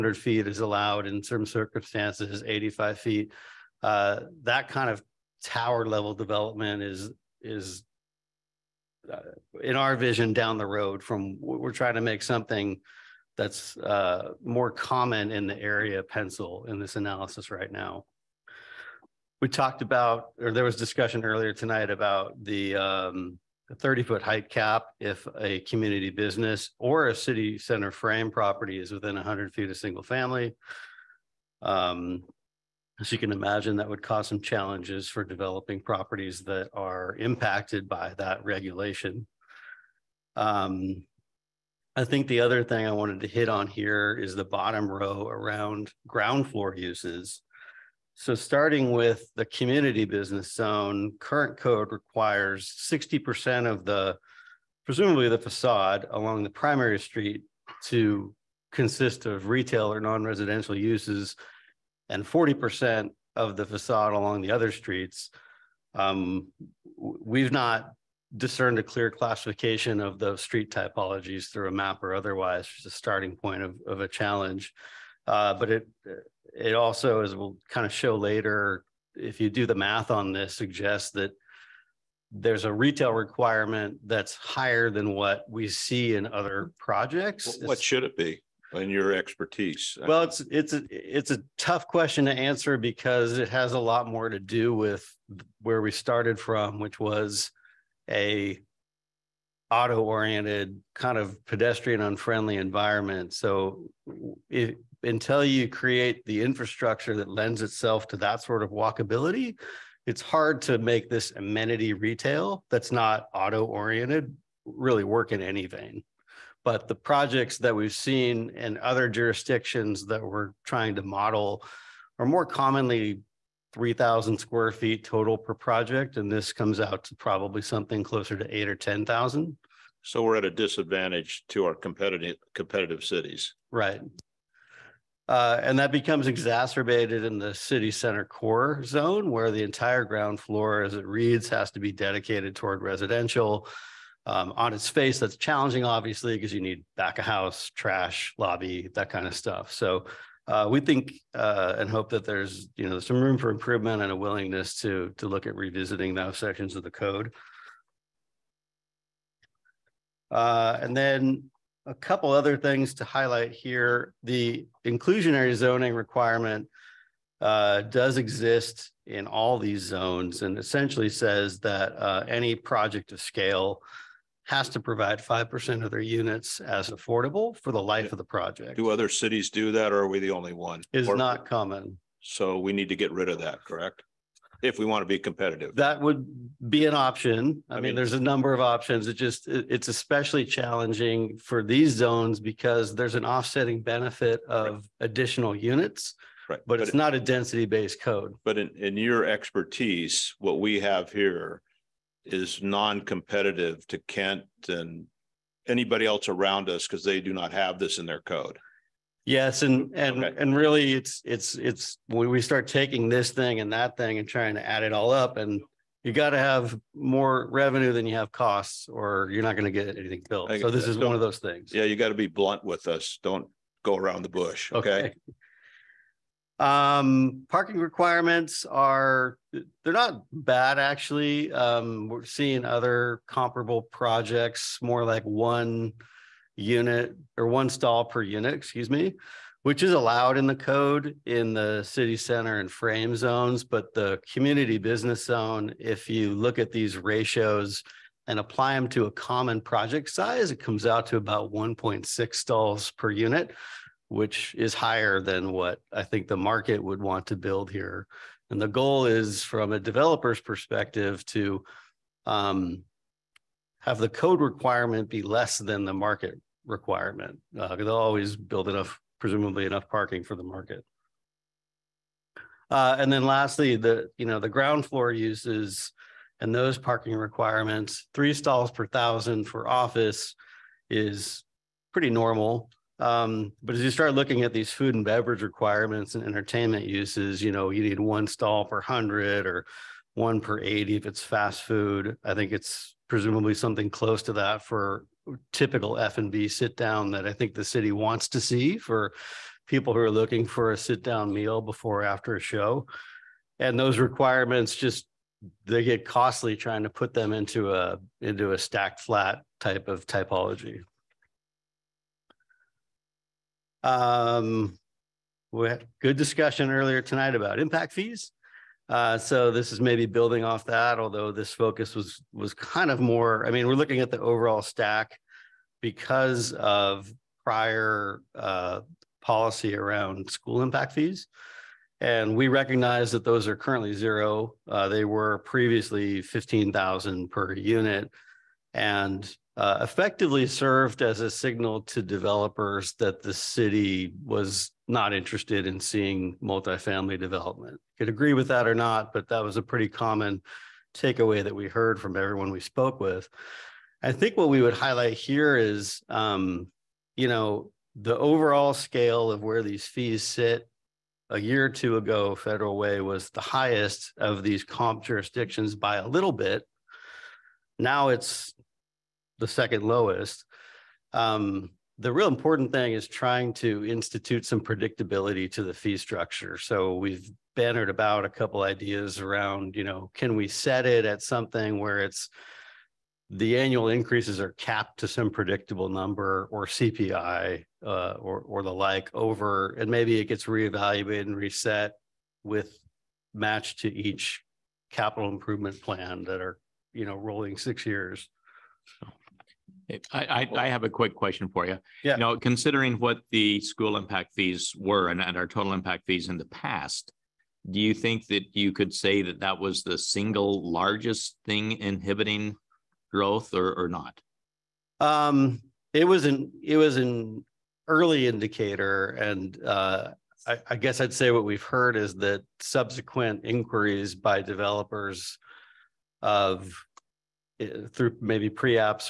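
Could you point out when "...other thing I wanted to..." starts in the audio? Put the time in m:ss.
0:42.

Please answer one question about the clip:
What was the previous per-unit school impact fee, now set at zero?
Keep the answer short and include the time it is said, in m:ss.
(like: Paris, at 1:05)
$15,000, at 5:36.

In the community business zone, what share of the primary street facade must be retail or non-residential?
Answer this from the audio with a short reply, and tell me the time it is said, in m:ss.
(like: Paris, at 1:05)
60%, at 0:52.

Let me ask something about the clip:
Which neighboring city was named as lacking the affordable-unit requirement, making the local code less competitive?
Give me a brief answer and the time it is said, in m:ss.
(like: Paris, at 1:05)
Kent, at 3:24.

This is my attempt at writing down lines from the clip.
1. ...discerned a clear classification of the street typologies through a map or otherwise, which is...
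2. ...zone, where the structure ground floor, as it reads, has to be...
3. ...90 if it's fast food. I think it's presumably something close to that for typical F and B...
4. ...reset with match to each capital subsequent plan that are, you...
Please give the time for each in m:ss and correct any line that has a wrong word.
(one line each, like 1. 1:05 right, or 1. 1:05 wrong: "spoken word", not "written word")
1. 1:08 right
2. 2:18 wrong: "entire", not "structure"
3. 4:50 wrong: "80", not "90"
4. 6:31 wrong: "improvement", not "subsequent".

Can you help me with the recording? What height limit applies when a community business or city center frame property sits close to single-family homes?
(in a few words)
30 feet.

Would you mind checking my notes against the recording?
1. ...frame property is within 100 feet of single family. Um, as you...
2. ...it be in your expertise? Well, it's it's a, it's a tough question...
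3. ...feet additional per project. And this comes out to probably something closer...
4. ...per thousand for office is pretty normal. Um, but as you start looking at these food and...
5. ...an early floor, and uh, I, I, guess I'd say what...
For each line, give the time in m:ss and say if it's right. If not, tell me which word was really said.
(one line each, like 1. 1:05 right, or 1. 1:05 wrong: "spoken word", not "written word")
1. 0:27 right
2. 1:28 right
3. 2:04 wrong: "total", not "additional"
4. 4:38 right
5. 6:56 wrong: "indicator", not "floor".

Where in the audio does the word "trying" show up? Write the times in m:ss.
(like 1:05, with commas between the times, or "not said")
0:11, 2:00, 3:34, 5:06, 6:13.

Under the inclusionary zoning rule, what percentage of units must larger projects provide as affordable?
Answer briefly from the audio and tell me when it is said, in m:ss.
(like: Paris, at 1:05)
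5%, at 2:55.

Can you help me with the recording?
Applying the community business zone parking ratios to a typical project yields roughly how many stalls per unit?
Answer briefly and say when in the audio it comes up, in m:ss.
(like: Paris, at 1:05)
1.6, at 4:11.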